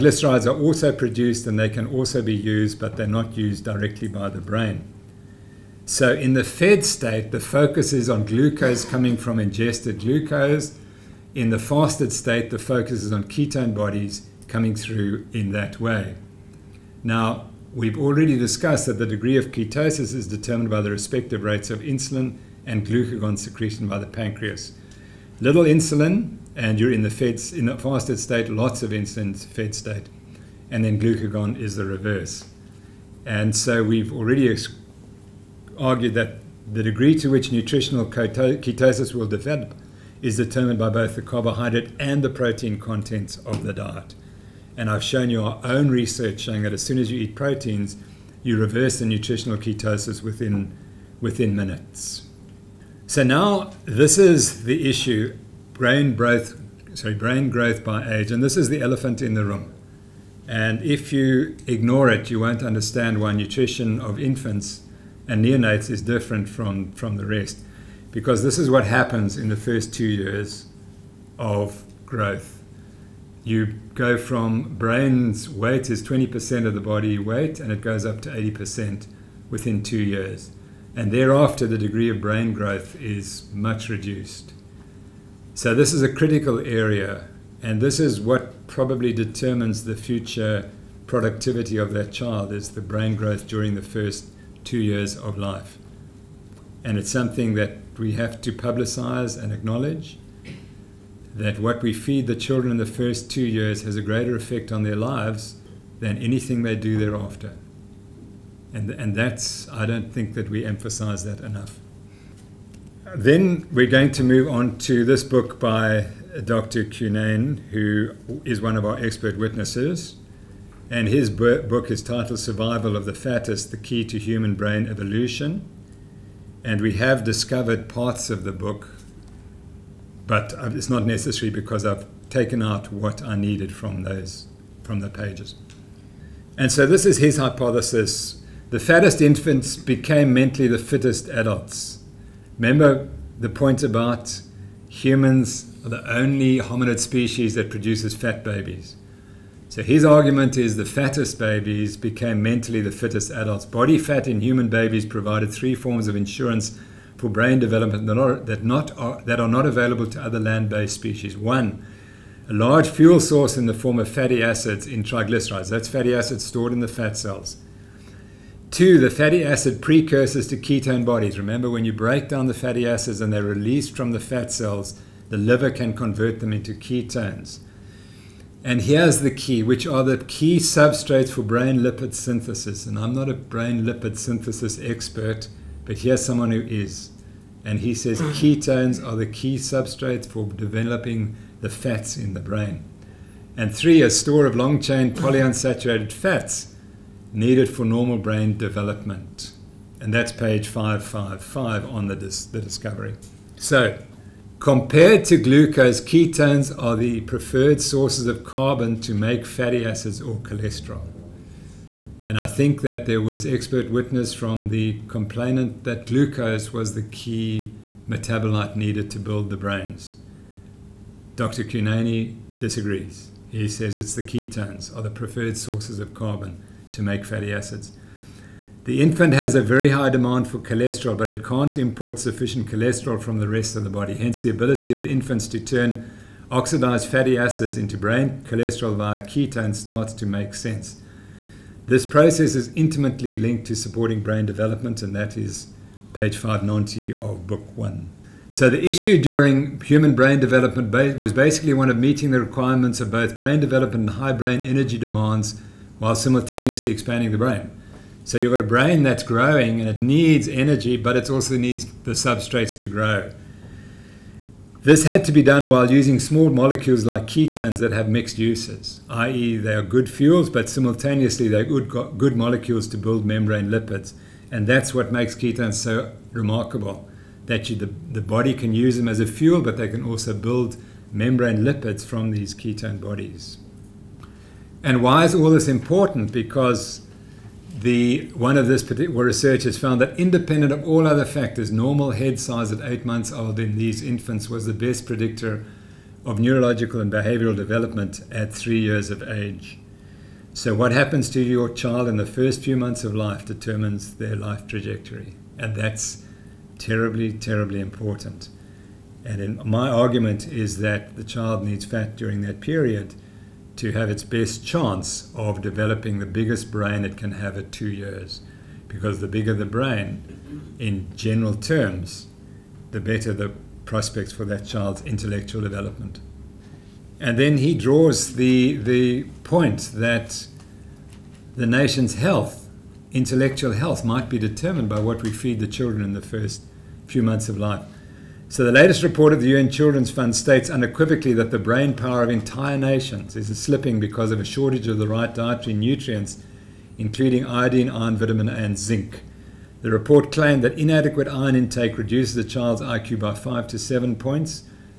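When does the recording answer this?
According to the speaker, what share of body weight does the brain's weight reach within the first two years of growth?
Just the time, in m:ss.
1:18.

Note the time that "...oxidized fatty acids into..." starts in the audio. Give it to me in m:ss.
3:56.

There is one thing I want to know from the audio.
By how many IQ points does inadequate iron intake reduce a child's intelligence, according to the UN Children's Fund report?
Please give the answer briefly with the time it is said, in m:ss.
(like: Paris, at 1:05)
5 to 7, at 5:53.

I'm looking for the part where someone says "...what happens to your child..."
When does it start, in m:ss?
5:00.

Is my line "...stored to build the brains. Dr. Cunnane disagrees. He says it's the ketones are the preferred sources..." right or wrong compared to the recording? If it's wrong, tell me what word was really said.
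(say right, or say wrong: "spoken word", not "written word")
wrong: "needed", not "stored".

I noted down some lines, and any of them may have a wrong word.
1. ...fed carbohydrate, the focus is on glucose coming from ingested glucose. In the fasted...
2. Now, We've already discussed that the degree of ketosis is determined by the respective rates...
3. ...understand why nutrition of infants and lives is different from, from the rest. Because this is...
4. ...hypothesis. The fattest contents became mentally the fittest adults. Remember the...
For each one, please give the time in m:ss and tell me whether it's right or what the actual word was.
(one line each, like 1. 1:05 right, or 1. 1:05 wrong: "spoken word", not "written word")
1. 0:06 wrong: "state", not "carbohydrate"
2. 0:17 right
3. 1:02 wrong: "neonates", not "lives"
4. 2:17 wrong: "infants", not "contents".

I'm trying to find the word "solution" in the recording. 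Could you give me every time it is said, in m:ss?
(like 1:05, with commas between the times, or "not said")
not said.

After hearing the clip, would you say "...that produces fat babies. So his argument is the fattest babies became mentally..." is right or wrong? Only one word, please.
right.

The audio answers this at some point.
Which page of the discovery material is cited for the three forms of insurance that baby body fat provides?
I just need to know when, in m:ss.
3:20.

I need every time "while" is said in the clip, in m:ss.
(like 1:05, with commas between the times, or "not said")
4:15, 4:25.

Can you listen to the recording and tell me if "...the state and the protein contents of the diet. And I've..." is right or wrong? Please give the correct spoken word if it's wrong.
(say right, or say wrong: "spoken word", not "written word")
wrong: "carbohydrate", not "state".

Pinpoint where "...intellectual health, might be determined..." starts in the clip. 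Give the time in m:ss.
5:33.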